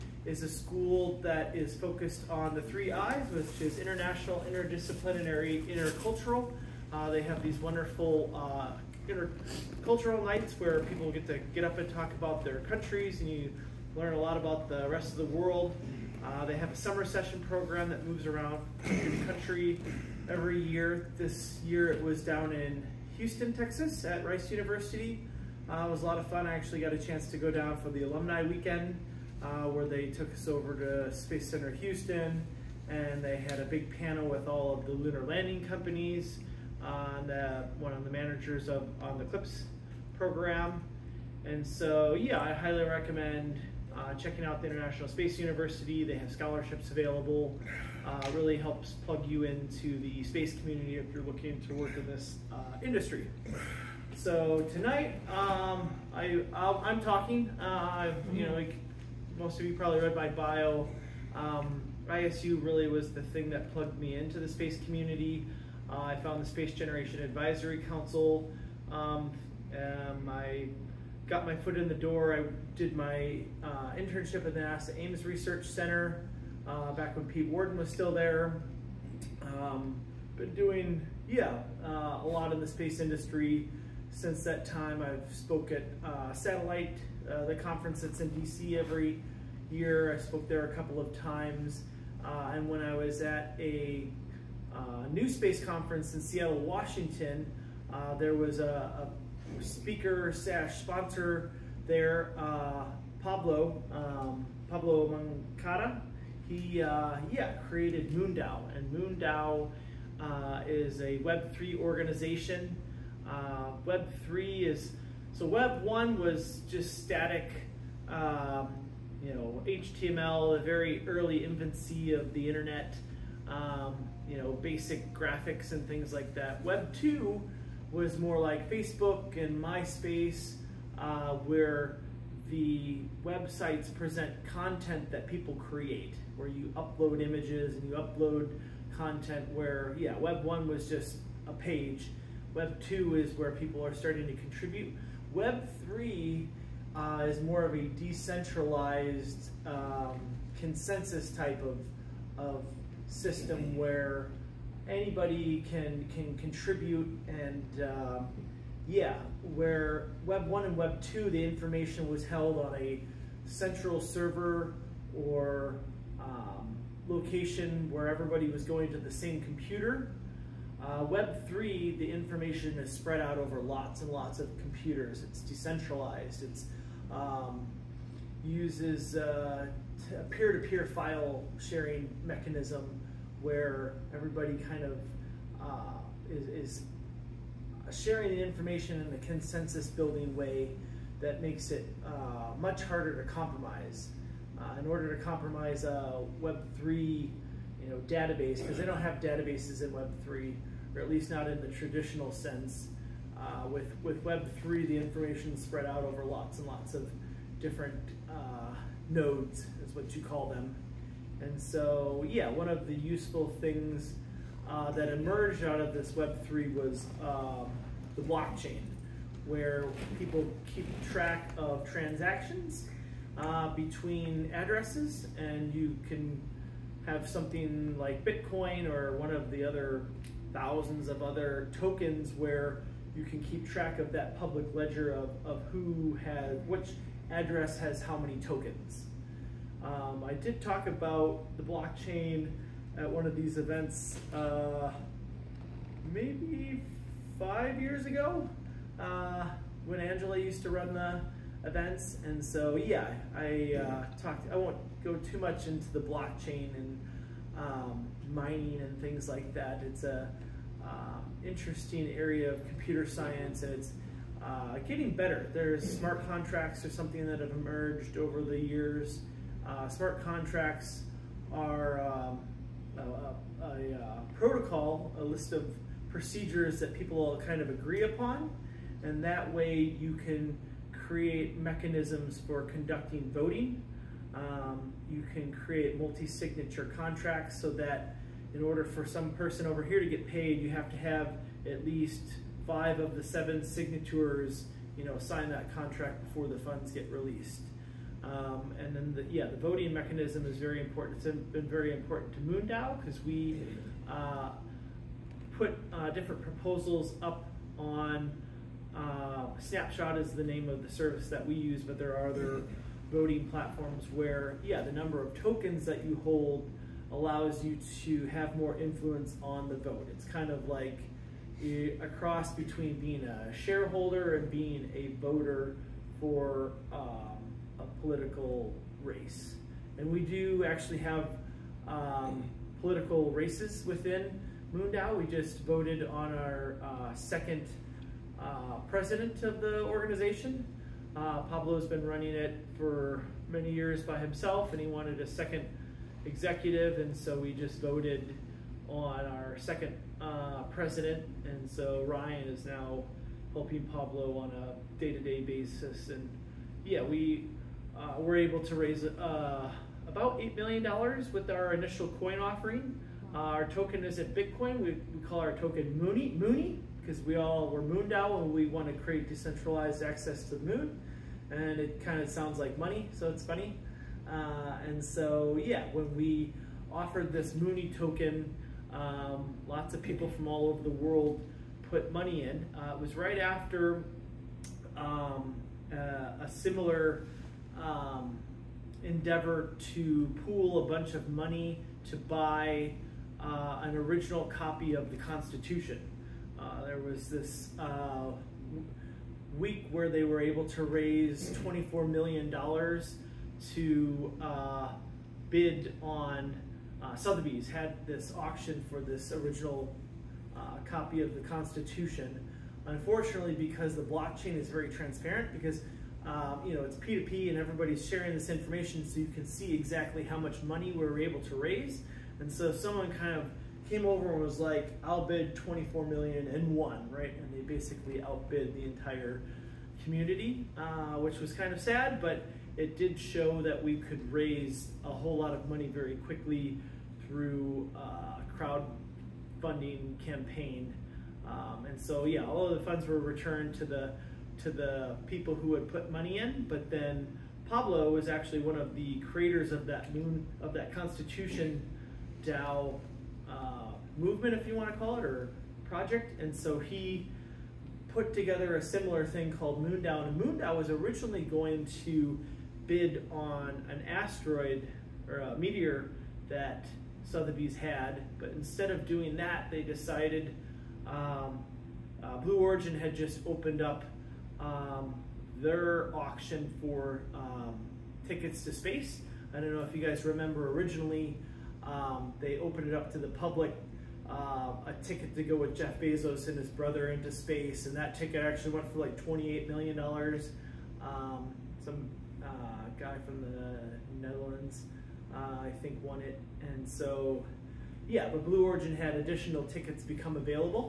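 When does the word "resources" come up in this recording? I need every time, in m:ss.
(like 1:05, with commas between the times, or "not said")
not said.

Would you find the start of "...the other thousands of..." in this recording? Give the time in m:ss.
3:49.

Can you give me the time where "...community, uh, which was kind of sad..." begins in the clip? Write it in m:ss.
7:10.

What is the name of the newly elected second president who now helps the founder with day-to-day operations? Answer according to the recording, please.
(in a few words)
Ryan.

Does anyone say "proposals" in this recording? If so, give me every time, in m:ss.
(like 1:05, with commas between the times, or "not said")
5:06.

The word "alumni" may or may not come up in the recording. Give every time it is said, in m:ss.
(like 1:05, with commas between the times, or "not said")
0:28.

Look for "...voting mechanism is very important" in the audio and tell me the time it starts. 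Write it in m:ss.
4:59.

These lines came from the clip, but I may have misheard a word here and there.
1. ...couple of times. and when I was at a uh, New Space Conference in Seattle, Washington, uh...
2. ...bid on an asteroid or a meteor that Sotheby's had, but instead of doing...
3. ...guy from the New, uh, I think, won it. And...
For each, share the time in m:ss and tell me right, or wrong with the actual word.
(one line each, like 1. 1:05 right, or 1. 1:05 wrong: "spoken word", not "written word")
1. 1:30 right
2. 7:42 right
3. 8:12 wrong: "Netherlands", not "New".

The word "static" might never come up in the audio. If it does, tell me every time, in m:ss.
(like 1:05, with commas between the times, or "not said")
1:57.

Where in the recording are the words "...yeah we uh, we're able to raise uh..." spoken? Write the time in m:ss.
5:56.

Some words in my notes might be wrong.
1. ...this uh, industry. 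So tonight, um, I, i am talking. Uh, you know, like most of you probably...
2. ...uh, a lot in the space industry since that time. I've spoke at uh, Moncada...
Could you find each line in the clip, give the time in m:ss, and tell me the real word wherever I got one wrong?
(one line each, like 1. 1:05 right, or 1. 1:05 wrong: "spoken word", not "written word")
1. 0:52 right
2. 1:21 wrong: "Satellite", not "Moncada".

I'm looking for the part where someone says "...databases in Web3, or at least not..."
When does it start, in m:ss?
3:19.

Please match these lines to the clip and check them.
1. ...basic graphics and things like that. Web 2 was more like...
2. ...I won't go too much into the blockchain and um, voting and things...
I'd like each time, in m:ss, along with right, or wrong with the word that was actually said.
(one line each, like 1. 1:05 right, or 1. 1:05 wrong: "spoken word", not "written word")
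1. 2:04 right
2. 4:14 wrong: "mining", not "voting".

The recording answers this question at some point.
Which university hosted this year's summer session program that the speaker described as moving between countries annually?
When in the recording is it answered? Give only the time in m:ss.
0:24.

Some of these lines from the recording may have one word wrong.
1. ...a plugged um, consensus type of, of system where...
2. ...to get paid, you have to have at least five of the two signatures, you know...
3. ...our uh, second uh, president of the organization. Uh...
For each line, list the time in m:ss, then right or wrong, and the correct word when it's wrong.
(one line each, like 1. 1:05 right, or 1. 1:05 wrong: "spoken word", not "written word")
1. 2:27 wrong: "decentralized", not "plugged"
2. 4:49 wrong: "seven", not "two"
3. 5:36 right.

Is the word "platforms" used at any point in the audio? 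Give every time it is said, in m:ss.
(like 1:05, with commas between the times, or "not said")
5:13.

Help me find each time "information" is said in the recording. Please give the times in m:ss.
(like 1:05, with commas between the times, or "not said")
2:41, 2:52, 3:08, 3:24, 6:58.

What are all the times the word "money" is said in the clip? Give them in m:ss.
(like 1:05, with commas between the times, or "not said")
6:12, 6:22, 6:31, 7:00, 7:15, 7:26.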